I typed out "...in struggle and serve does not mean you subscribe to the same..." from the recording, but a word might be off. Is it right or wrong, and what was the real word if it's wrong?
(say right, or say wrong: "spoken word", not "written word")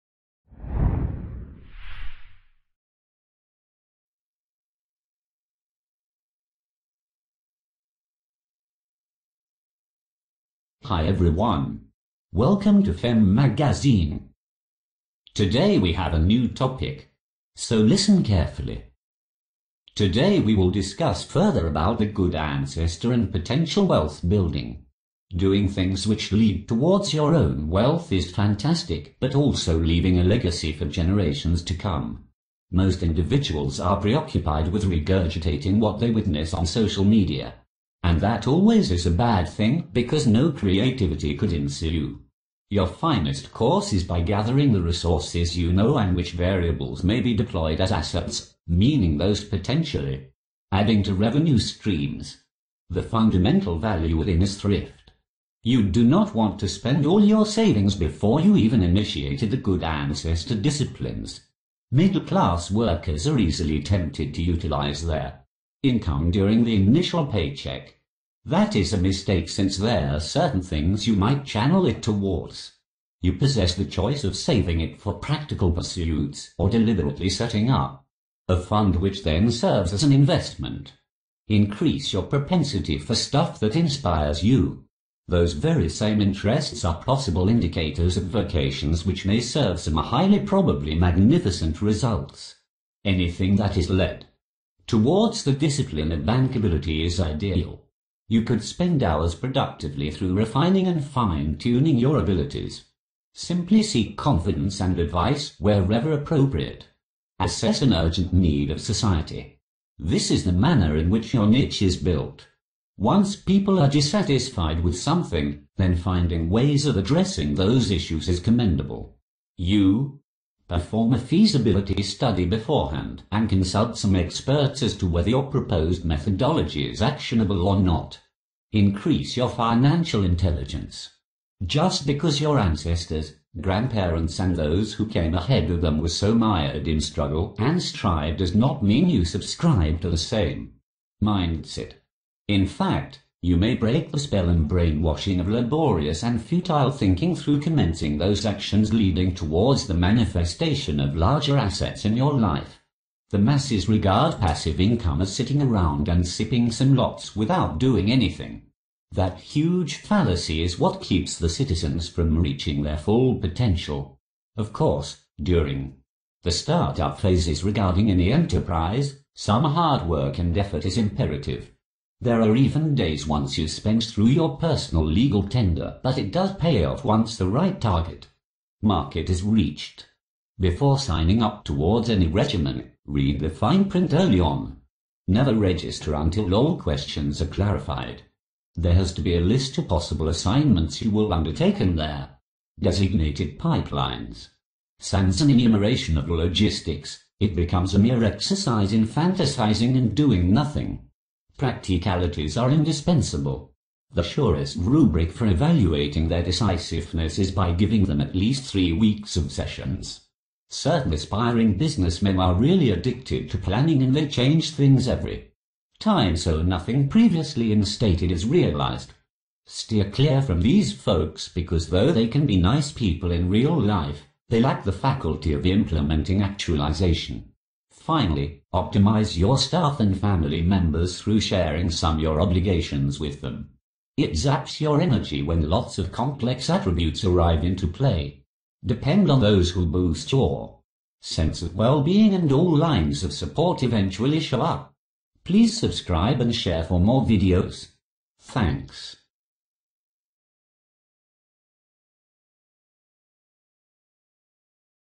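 wrong: "strive", not "serve".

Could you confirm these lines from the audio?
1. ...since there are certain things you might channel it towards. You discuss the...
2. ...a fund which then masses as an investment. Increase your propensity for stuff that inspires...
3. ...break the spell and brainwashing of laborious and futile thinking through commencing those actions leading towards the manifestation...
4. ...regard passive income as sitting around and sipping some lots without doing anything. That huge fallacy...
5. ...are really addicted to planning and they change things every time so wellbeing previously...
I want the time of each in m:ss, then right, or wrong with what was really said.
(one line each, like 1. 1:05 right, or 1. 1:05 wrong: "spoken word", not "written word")
1. 1:09 wrong: "possess", not "discuss"
2. 1:18 wrong: "serves", not "masses"
3. 2:23 right
4. 2:33 right
5. 3:32 wrong: "nothing", not "wellbeing".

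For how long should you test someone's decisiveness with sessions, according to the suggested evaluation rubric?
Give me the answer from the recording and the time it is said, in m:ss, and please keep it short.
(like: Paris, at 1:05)
3 weeks, at 3:28.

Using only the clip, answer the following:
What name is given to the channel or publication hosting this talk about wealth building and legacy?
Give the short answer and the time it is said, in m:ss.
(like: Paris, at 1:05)
Femme Magazine, at 0:12.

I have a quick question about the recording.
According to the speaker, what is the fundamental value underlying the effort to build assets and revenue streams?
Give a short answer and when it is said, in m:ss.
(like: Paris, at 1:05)
Thrift, at 0:54.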